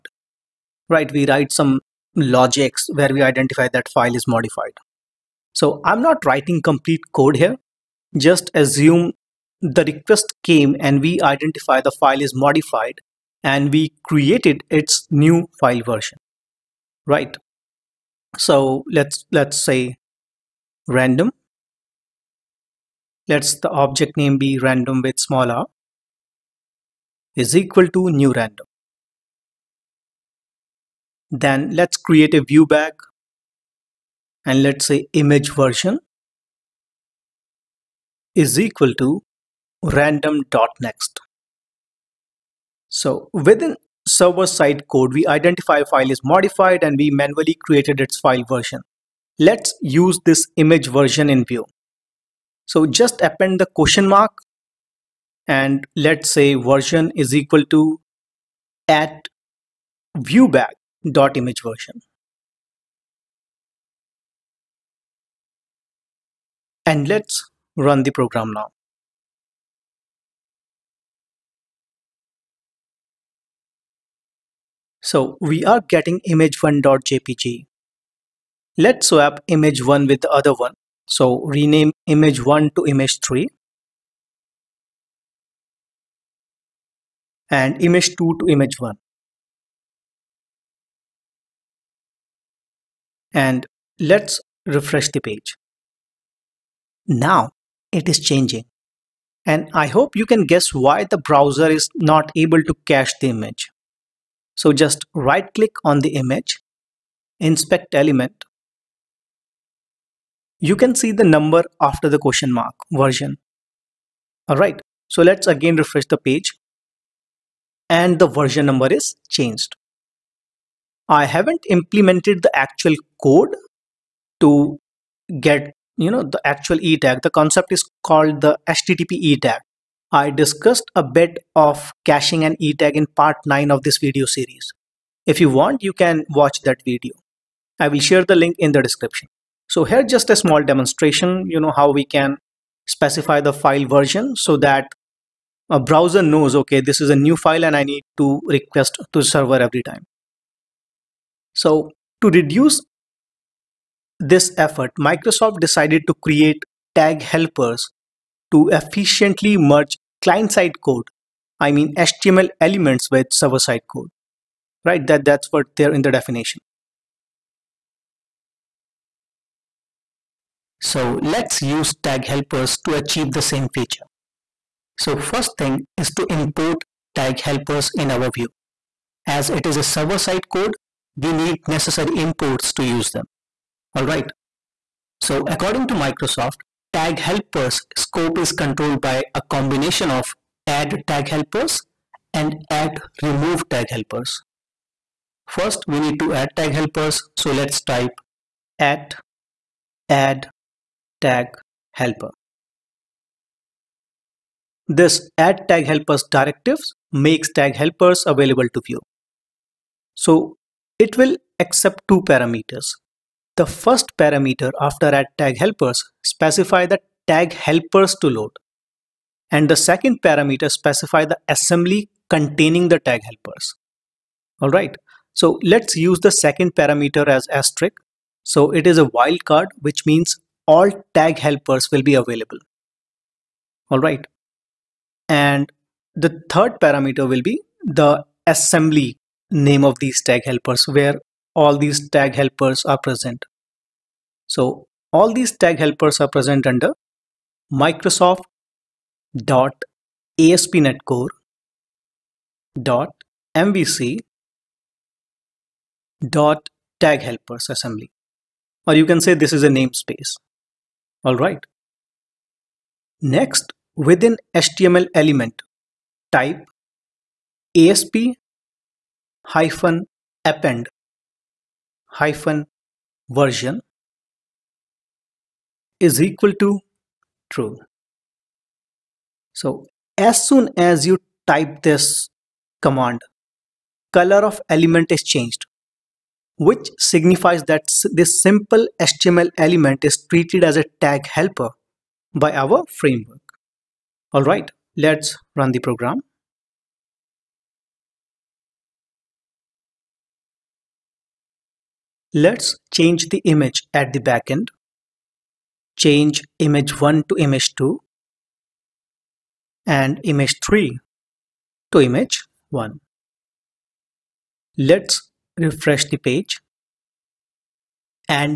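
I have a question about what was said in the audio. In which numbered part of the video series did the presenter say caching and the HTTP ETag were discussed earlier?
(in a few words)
part 9.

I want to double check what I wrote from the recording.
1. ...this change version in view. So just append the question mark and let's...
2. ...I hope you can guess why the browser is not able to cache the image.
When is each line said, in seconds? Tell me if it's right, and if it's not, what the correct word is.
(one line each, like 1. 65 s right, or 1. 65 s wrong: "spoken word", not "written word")
1. 50 s wrong: "image", not "change"
2. 99 s right.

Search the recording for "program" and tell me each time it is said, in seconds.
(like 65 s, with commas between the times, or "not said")
68 s, 295 s.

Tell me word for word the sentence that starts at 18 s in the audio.
So let's, let's say random Let's the object name be random with small r is equal to new random.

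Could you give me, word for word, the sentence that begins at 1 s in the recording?
We write some logics where we identify that file is modified.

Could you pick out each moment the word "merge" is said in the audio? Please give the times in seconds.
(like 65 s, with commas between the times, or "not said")
159 s.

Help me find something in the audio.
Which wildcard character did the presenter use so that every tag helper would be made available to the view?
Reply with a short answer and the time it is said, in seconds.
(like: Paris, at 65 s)
asterisk, at 227 s.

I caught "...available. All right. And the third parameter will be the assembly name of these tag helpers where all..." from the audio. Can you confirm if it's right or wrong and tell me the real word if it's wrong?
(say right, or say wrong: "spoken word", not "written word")
right.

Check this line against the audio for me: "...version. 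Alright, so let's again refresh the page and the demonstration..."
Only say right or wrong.
wrong.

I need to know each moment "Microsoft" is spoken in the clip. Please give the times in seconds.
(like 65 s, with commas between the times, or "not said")
154 s, 185 s, 247 s.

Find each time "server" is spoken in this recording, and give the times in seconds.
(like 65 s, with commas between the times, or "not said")
44 s, 149 s, 163 s, 179 s.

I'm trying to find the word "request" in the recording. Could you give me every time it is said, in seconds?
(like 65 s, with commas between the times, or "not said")
9 s, 148 s.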